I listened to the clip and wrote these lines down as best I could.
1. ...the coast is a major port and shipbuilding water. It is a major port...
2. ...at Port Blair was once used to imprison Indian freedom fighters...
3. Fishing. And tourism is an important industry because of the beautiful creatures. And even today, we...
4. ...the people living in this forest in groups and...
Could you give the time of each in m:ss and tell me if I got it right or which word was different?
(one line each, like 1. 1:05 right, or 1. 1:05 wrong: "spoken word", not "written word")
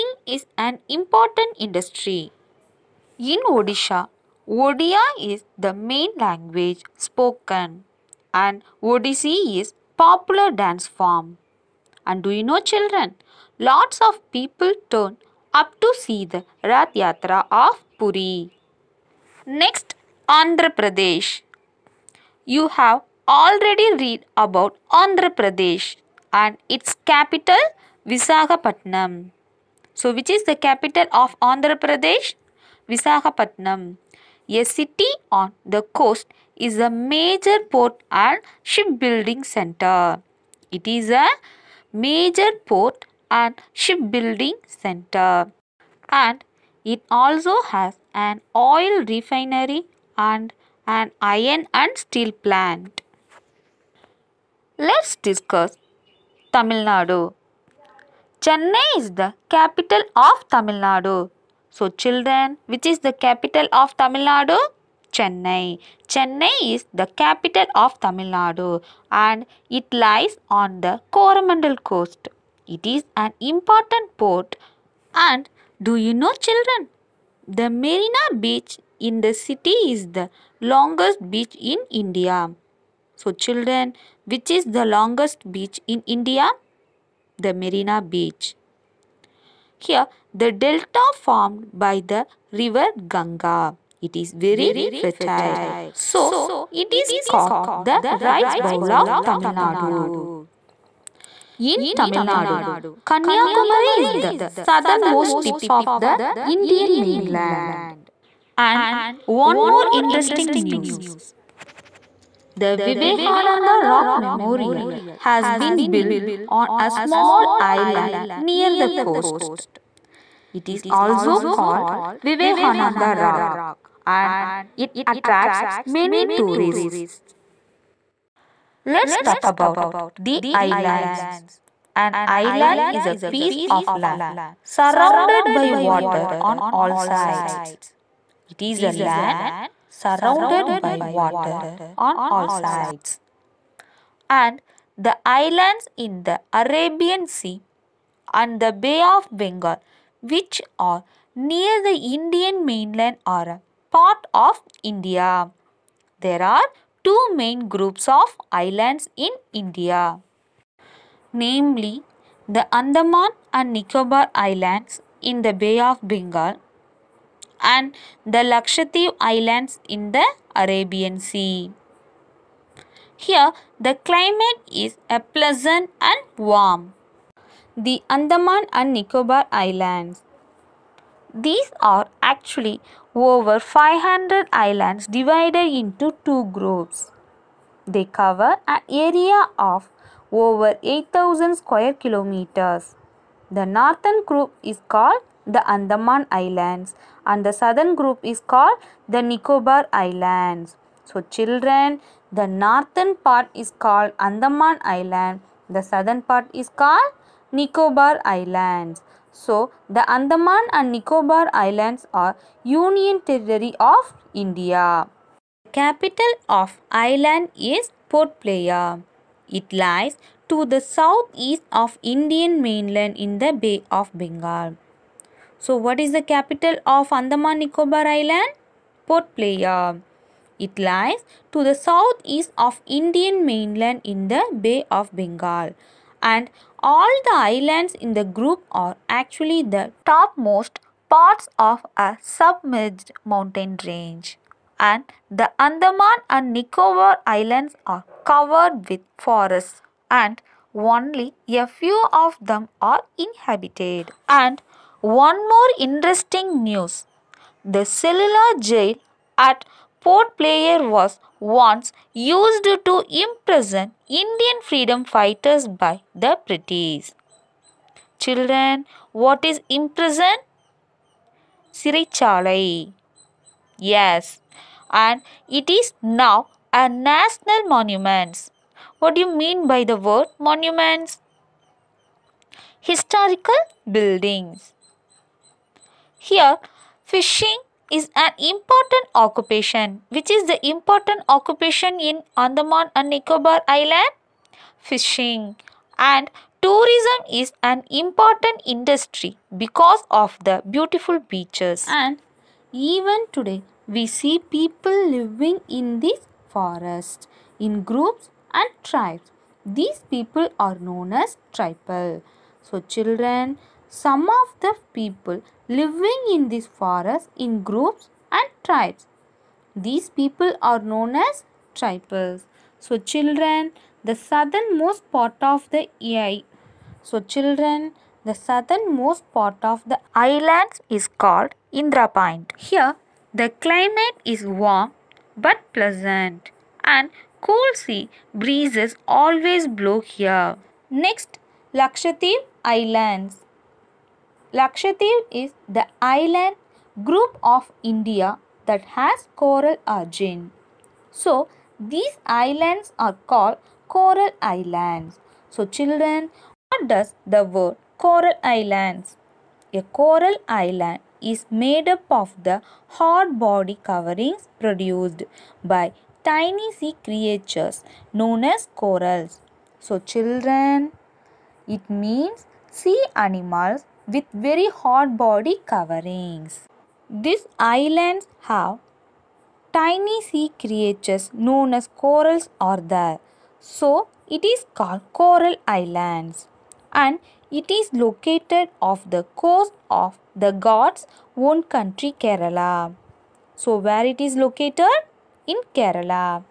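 1. 0:35 wrong: "center", not "water"
2. 4:19 right
3. 4:54 wrong: "beaches", not "creatures"
4. 5:14 right.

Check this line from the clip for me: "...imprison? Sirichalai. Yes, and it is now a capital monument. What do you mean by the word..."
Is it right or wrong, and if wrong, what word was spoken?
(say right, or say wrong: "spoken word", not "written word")
wrong: "national", not "capital".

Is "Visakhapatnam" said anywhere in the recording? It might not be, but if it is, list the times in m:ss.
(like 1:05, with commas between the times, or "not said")
0:28, 0:32.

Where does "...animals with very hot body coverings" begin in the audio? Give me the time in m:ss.
6:13.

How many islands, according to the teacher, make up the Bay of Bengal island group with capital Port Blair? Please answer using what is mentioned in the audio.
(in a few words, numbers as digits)
500.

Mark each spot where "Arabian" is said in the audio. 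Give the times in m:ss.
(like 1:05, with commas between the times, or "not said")
2:26, 2:50.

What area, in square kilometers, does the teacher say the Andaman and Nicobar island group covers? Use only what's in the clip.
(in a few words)
Over 8000 square kilometers.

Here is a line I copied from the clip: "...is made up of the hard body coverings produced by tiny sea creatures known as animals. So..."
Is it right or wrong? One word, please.
wrong.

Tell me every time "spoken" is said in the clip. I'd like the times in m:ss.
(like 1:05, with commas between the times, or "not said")
0:06.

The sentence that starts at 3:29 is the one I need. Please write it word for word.
So, the Andaman and Nicobar Islands are Union Territory of India.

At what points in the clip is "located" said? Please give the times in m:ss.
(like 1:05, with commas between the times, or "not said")
6:27, 6:34.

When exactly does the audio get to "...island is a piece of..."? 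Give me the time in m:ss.
2:12.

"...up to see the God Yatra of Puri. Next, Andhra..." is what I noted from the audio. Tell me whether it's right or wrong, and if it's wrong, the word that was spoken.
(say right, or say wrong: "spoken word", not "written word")
wrong: "Rath", not "God".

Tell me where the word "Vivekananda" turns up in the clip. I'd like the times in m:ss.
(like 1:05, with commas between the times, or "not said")
1:52, 2:02.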